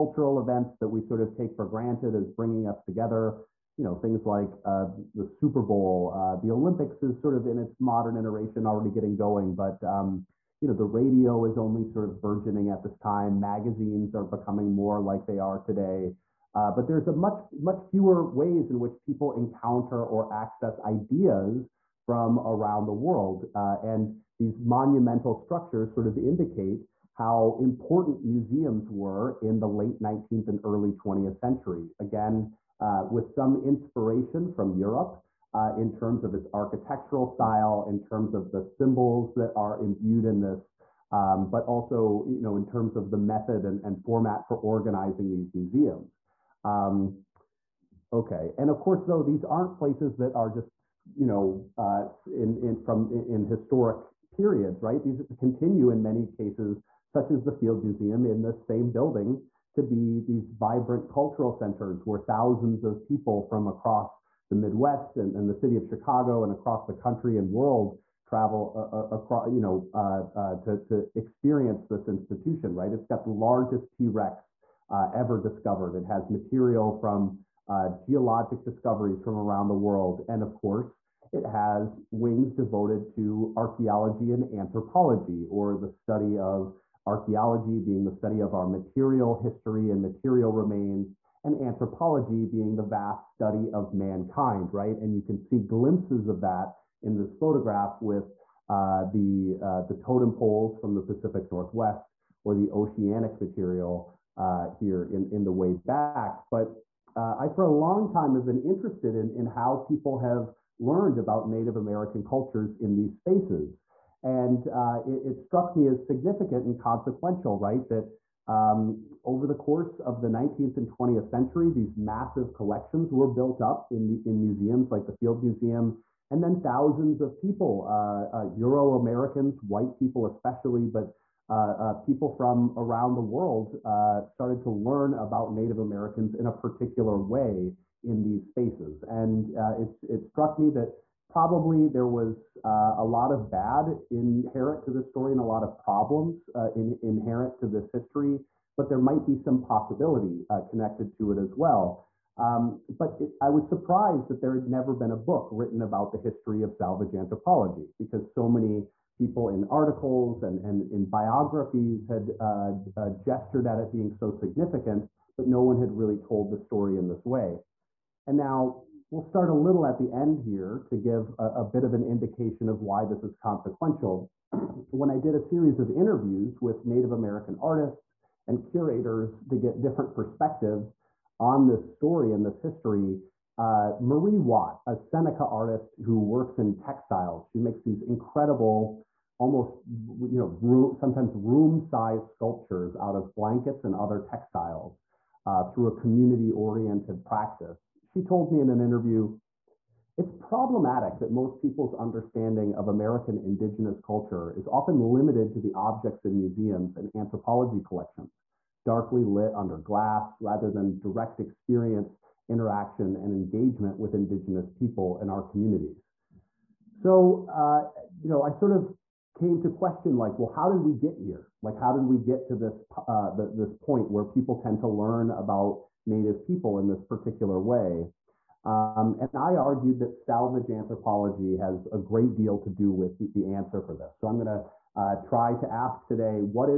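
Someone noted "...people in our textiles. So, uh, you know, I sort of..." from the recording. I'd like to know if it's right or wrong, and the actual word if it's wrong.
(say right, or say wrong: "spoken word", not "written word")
wrong: "communities", not "textiles".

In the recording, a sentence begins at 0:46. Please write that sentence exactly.
Um, Okay, and of course, though these aren't places that are just you know uh, in in from in historic periods, right?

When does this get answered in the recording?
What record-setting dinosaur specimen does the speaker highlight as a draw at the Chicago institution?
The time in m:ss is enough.
1:13.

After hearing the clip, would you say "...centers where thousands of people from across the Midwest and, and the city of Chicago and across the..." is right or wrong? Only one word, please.
right.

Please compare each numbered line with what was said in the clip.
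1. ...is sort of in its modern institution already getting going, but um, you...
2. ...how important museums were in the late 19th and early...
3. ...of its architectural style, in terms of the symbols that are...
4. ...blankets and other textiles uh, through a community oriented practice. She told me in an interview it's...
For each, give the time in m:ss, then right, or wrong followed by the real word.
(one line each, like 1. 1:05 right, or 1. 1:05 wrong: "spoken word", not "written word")
1. 0:07 wrong: "iteration", not "institution"
2. 0:27 right
3. 0:36 right
4. 3:13 right.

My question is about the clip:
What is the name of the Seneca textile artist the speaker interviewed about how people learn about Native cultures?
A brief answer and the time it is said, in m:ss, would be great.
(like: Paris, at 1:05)
Marie Watt, at 3:04.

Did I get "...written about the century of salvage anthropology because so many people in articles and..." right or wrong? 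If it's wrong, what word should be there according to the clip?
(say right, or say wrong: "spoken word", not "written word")
wrong: "history", not "century".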